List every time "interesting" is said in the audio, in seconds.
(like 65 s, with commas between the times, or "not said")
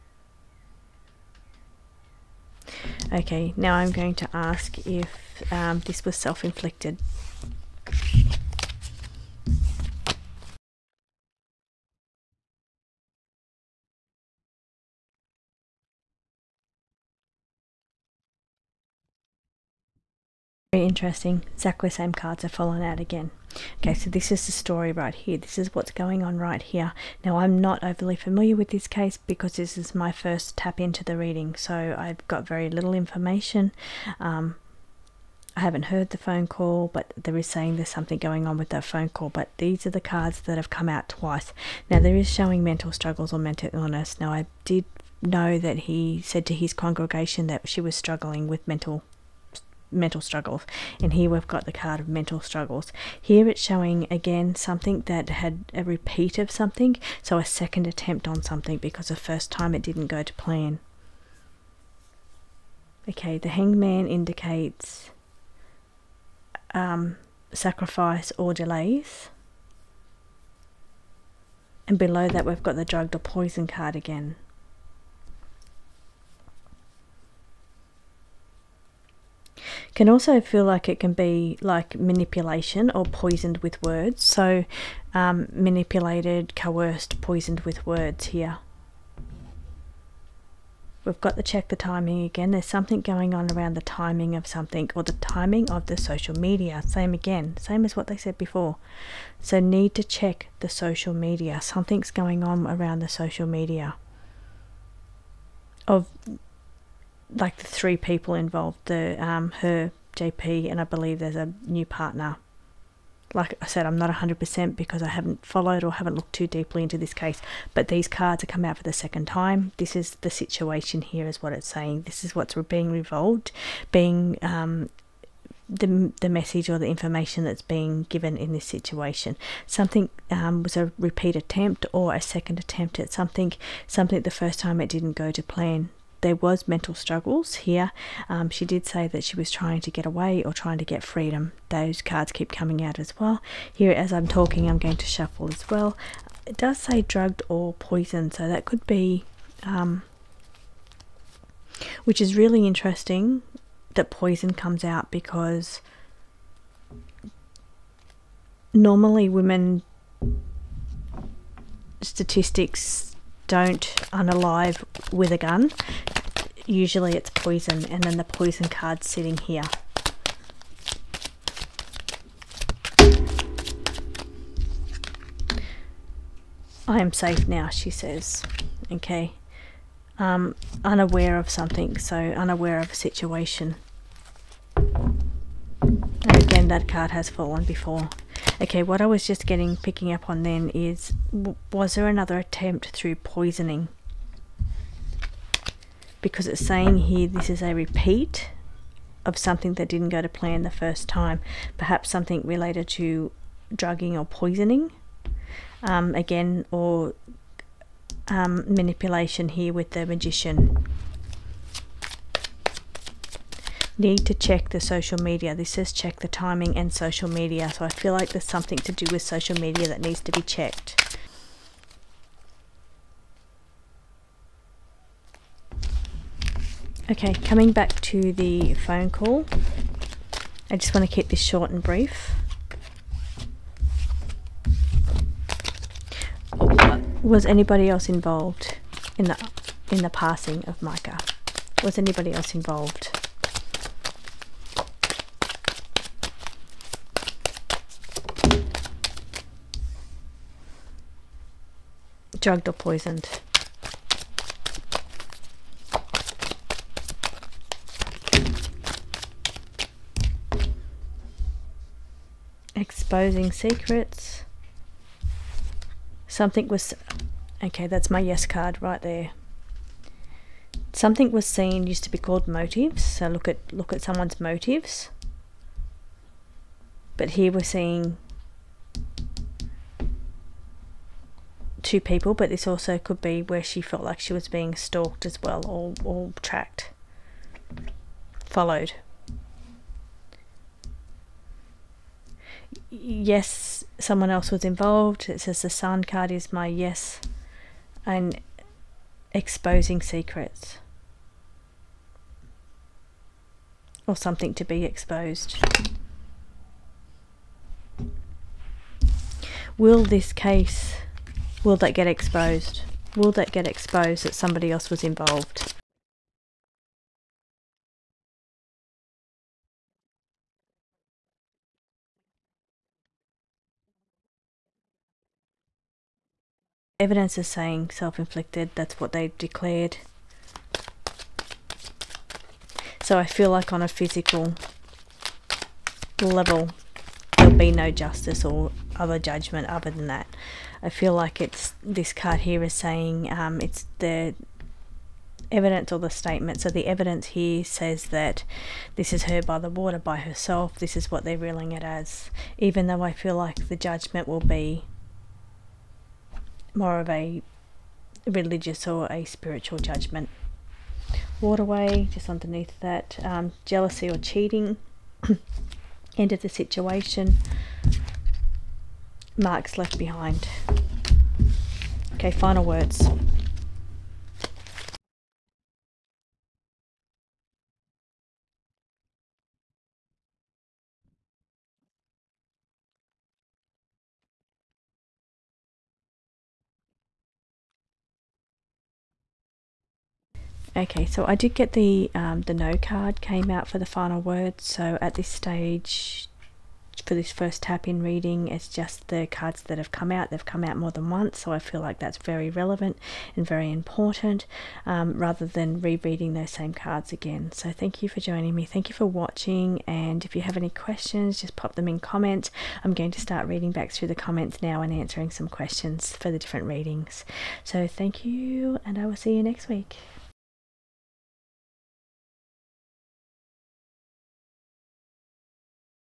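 20 s, 152 s.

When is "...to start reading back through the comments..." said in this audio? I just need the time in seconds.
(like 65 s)
413 s.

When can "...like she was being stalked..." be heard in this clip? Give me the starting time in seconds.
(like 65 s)
284 s.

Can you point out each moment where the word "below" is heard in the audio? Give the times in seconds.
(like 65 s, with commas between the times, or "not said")
71 s.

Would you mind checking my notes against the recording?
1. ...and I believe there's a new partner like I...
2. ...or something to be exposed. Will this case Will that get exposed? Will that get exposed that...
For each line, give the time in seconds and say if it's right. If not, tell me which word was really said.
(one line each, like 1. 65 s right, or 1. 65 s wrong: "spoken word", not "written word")
1. 110 s right
2. 304 s right.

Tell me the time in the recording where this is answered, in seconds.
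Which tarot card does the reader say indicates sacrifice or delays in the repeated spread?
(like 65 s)
63 s.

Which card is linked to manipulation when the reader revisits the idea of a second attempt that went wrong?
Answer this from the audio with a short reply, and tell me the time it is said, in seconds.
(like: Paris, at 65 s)
The Magician, at 209 s.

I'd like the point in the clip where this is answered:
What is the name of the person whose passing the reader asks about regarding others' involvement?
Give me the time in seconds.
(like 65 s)
240 s.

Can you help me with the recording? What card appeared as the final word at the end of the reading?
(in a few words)
The no card.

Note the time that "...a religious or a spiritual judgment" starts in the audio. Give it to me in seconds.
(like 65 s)
357 s.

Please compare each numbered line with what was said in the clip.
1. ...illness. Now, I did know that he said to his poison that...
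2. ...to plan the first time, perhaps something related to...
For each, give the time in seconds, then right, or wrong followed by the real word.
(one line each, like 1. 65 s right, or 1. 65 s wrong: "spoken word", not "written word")
1. 43 s wrong: "congregation", not "poison"
2. 200 s right.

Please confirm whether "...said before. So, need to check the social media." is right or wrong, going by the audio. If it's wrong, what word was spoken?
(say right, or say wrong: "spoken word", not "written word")
right.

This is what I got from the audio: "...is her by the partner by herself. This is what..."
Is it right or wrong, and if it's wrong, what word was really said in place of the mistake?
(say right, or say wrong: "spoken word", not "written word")
wrong: "water", not "partner".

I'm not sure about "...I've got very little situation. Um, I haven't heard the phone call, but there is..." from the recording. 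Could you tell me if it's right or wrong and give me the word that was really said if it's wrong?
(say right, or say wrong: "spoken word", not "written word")
wrong: "information", not "situation".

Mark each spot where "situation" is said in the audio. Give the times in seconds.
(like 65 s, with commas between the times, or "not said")
120 s, 128 s, 182 s, 366 s.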